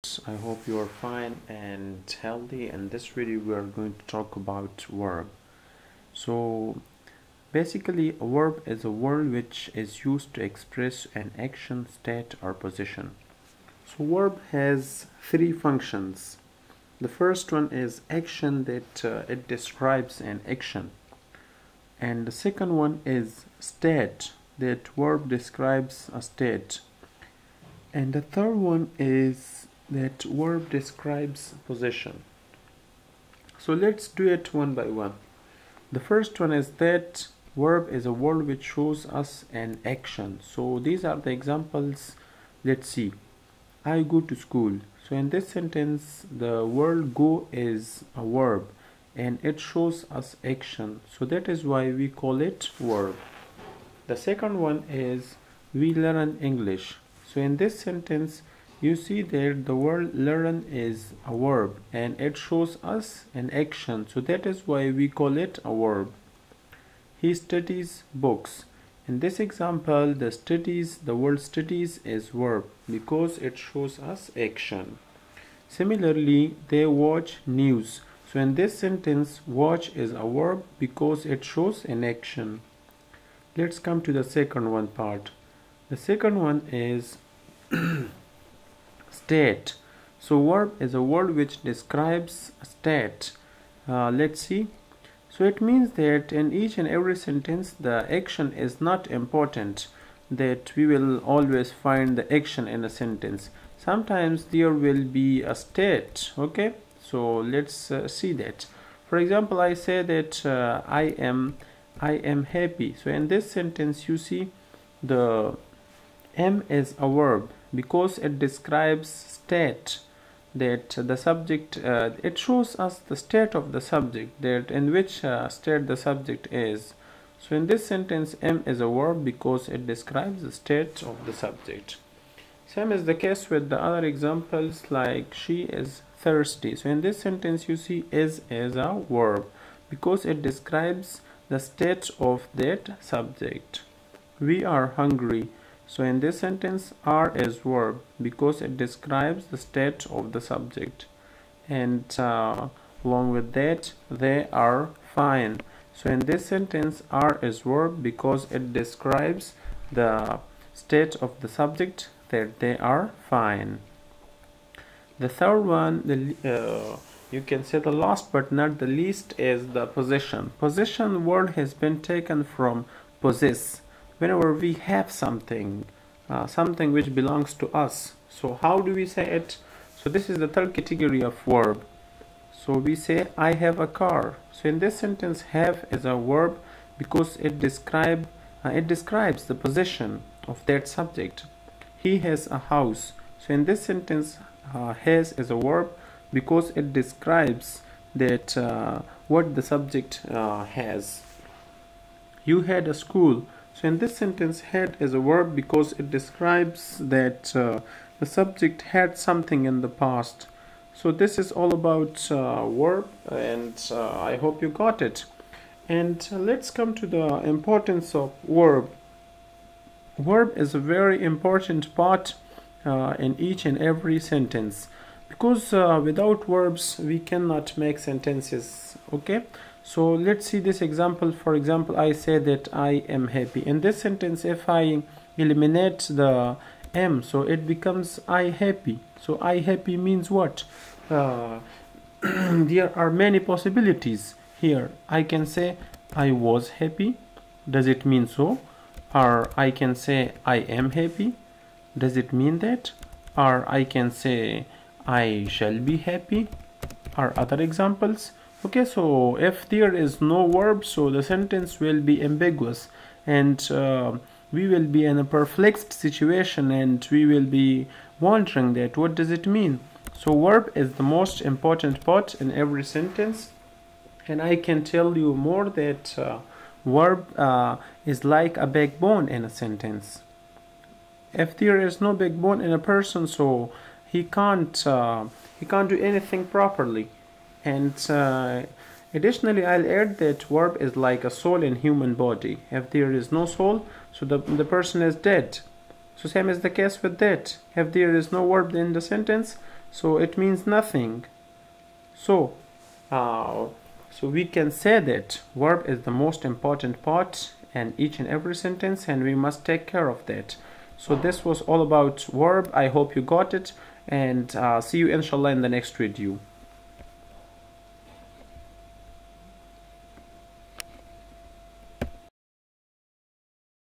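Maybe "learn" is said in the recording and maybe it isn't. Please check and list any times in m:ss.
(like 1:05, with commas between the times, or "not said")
0:55, 1:00.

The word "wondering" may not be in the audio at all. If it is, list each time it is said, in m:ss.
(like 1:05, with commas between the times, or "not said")
4:28.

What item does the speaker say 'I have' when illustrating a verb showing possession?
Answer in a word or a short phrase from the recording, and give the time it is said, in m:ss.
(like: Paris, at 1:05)
a car, at 3:03.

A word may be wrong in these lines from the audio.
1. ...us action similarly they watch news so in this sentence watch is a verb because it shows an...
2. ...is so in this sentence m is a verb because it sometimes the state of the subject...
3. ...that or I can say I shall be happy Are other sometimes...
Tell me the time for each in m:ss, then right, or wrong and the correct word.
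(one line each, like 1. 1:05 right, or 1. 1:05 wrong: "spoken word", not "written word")
1. 1:14 right
2. 2:06 wrong: "describes", not "sometimes"
3. 4:12 wrong: "examples", not "sometimes".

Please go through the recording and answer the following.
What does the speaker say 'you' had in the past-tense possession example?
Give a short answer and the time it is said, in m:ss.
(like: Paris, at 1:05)
a school, at 3:22.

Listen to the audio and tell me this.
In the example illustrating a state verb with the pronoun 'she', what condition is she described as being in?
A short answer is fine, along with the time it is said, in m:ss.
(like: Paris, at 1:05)
thirsty, at 2:15.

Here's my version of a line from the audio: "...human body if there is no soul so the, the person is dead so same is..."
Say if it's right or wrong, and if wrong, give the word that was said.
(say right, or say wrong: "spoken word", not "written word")
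right.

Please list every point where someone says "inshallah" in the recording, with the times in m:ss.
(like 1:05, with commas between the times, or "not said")
5:15.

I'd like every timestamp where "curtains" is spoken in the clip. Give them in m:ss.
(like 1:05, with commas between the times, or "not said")
not said.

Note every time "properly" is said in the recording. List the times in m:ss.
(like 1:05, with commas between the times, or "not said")
4:46.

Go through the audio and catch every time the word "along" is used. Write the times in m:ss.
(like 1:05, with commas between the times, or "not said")
2:33.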